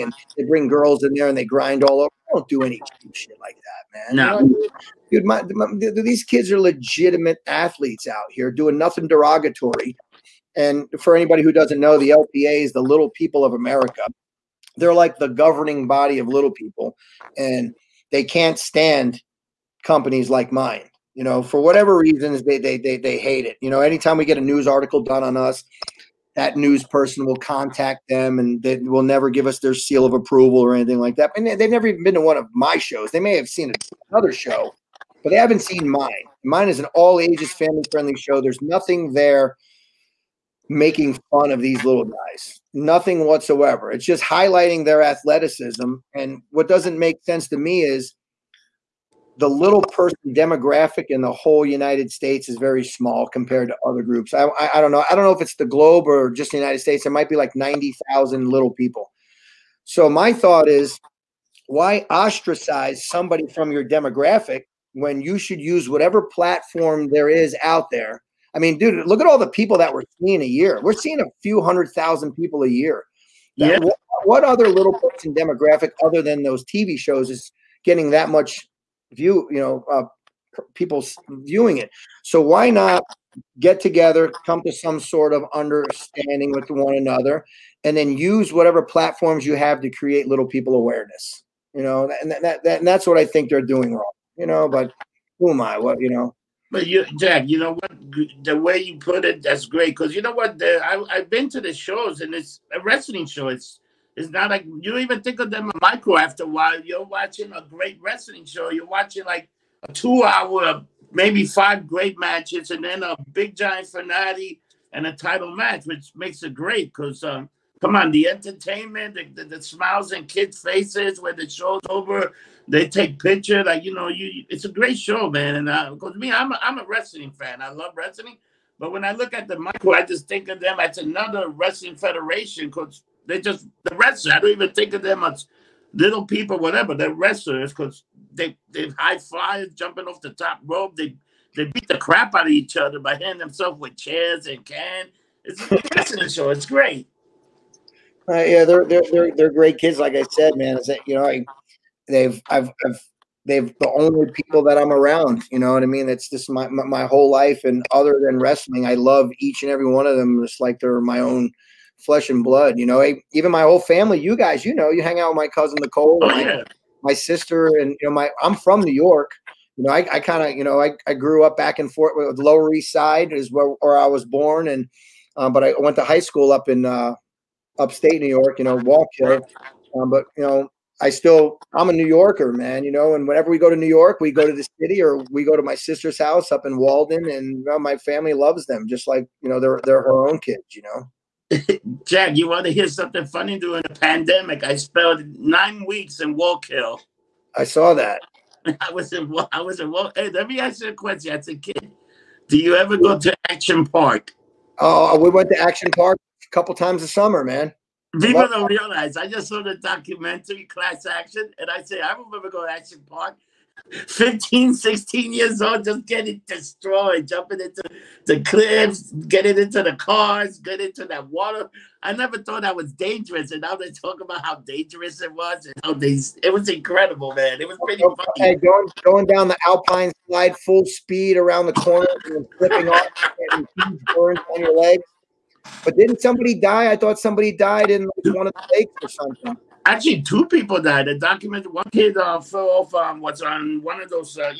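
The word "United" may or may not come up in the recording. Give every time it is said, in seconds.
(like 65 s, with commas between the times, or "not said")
51 s, 56 s.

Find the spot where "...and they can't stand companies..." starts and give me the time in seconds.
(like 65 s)
17 s.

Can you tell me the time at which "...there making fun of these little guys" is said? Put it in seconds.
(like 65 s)
39 s.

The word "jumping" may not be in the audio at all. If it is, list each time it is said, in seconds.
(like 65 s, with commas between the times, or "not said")
139 s, 217 s.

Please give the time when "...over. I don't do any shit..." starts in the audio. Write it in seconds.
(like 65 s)
1 s.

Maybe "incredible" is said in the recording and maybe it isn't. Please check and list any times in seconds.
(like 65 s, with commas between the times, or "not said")
226 s.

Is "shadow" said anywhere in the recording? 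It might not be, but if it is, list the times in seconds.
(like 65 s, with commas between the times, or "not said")
not said.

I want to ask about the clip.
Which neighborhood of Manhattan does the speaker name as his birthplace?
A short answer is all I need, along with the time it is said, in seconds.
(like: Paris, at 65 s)
Lower East Side, at 172 s.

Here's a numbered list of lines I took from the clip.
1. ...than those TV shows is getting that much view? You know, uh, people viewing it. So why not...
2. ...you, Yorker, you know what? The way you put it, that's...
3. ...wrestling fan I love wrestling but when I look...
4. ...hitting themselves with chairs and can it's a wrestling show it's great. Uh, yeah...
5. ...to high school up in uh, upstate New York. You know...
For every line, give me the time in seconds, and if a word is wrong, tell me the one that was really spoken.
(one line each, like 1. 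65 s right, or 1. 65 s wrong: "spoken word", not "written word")
1. 76 s right
2. 96 s wrong: "Jack", not "Yorker"
3. 126 s right
4. 143 s right
5. 175 s right.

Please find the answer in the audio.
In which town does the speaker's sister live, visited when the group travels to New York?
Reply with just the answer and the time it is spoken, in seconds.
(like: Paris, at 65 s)
Walden, at 186 s.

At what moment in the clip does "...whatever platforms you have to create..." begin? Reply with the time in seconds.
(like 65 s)
88 s.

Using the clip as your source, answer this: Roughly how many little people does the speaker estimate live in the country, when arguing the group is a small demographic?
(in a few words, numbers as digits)
90,000.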